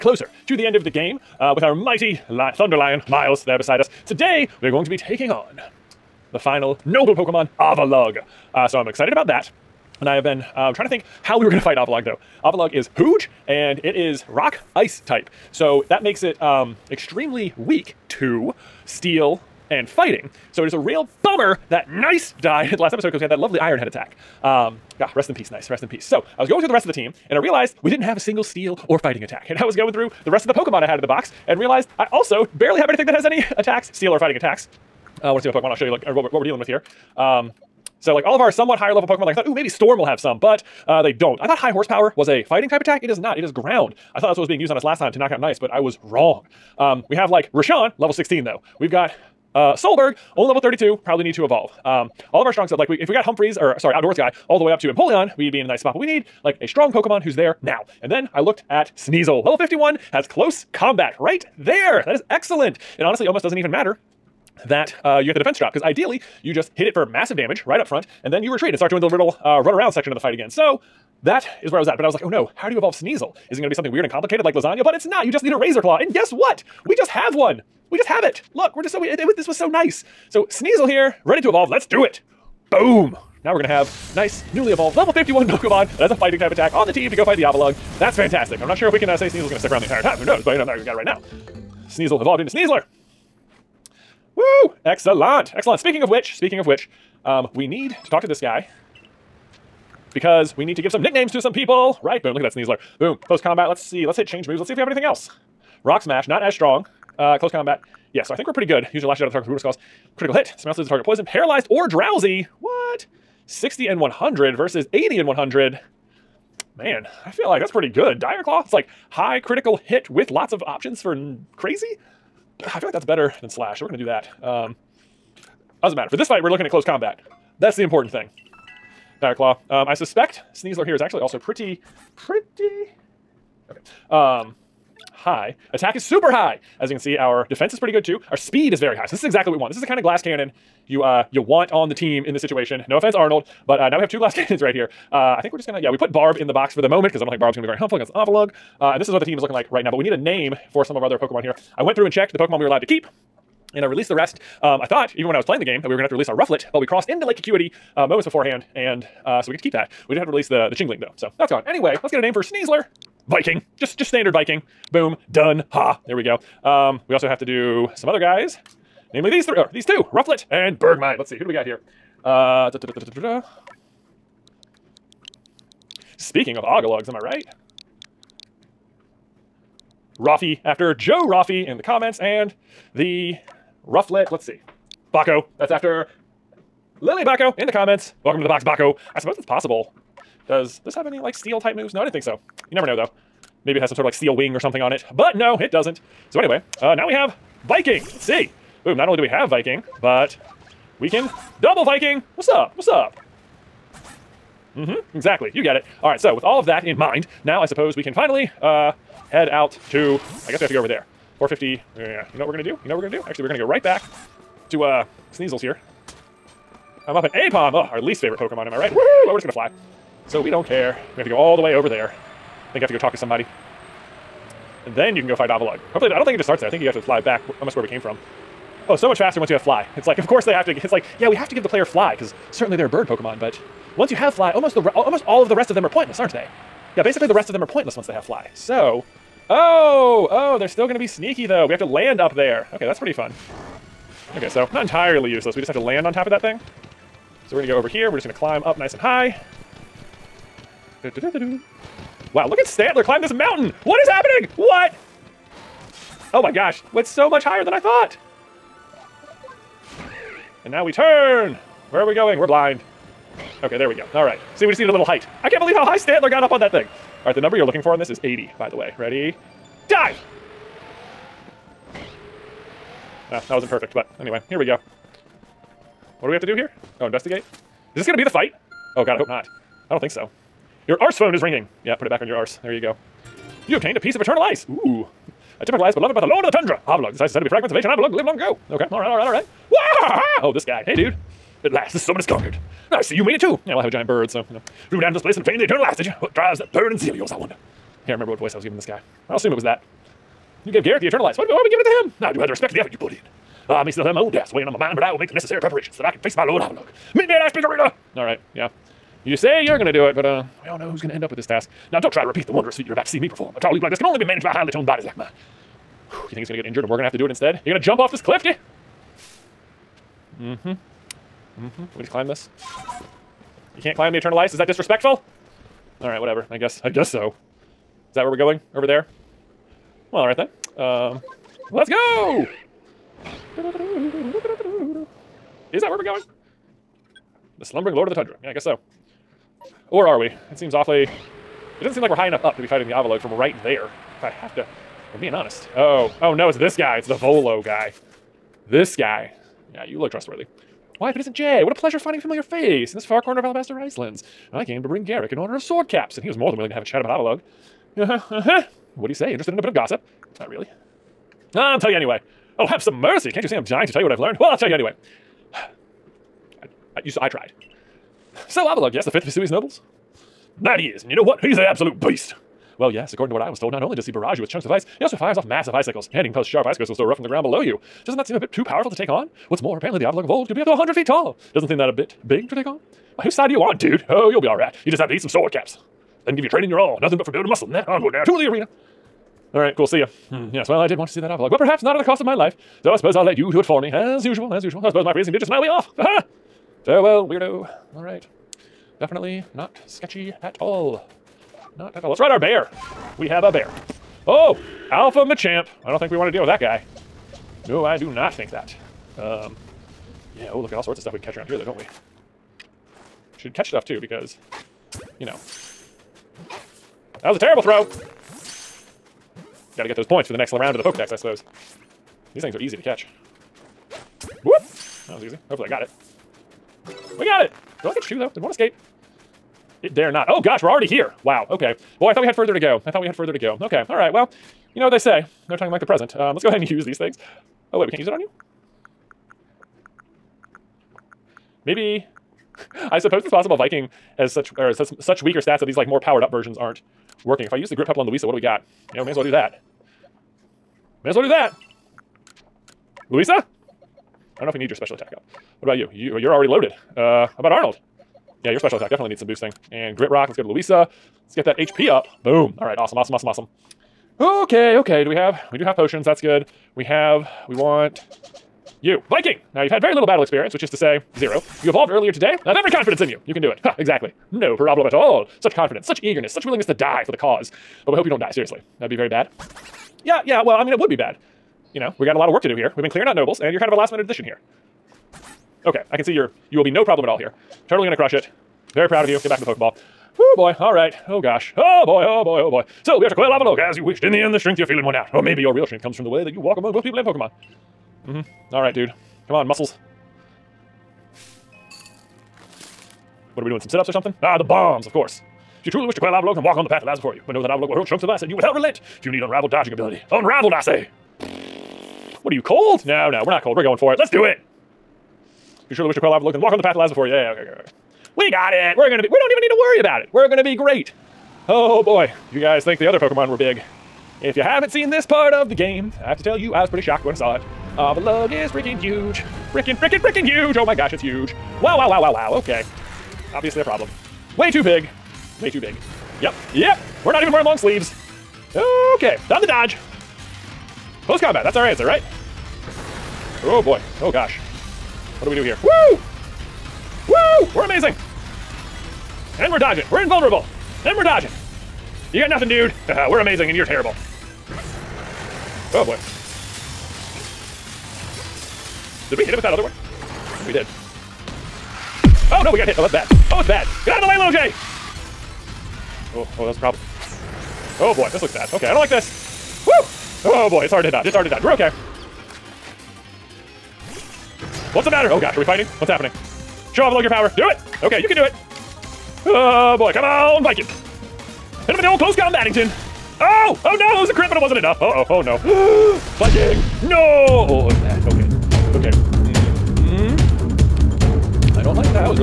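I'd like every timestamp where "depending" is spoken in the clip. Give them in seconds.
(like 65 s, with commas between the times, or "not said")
not said.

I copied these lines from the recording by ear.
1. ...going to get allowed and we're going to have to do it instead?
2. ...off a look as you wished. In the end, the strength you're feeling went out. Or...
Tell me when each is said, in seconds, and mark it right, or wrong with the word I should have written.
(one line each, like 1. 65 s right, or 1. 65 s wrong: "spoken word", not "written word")
1. 316 s wrong: "injured", not "allowed"
2. 493 s right.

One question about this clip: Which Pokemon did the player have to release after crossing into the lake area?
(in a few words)
Chingling.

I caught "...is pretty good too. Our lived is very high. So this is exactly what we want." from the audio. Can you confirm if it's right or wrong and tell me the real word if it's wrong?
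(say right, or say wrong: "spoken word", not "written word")
wrong: "speed", not "lived".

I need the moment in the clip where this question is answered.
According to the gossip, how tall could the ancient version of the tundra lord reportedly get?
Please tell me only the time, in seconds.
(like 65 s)
380 s.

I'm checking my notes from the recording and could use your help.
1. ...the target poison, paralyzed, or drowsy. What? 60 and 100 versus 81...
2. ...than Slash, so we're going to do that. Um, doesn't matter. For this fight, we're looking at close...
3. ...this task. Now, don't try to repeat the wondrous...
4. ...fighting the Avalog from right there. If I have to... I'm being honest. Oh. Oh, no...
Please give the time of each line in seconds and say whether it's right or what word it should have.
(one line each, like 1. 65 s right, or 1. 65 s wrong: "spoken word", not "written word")
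1. 110 s wrong: "80", not "81"
2. 123 s right
3. 311 s right
4. 342 s right.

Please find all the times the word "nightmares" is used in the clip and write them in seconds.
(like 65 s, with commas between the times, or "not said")
not said.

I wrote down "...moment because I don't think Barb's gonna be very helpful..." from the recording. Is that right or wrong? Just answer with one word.
right.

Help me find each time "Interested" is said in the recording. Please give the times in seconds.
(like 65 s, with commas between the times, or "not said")
359 s.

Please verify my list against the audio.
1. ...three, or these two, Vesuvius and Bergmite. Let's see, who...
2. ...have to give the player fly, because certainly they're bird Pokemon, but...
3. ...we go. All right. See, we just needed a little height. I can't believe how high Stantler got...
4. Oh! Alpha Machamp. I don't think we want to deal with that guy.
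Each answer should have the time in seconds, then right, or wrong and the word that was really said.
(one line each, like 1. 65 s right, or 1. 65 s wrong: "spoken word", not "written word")
1. 169 s wrong: "Rufflet", not "Vesuvius"
2. 231 s right
3. 263 s right
4. 404 s right.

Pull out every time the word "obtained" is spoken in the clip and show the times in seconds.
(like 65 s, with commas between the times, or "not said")
283 s, 295 s.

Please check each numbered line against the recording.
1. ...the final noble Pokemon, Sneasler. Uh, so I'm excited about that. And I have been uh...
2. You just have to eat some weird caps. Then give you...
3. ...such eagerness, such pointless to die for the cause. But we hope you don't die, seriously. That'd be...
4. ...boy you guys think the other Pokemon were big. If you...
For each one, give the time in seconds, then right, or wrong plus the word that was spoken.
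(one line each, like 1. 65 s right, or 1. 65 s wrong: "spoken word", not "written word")
1. 6 s wrong: "Avalugg", not "Sneasler"
2. 384 s wrong: "sword", not "weird"
3. 475 s wrong: "willingness", not "pointless"
4. 521 s right.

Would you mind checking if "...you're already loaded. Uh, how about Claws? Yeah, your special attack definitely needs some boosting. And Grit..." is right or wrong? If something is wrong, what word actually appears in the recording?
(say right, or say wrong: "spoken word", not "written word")
wrong: "Arnold", not "Claws".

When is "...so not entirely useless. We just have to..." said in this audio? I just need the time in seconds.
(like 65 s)
244 s.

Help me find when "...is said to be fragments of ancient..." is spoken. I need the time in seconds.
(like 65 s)
287 s.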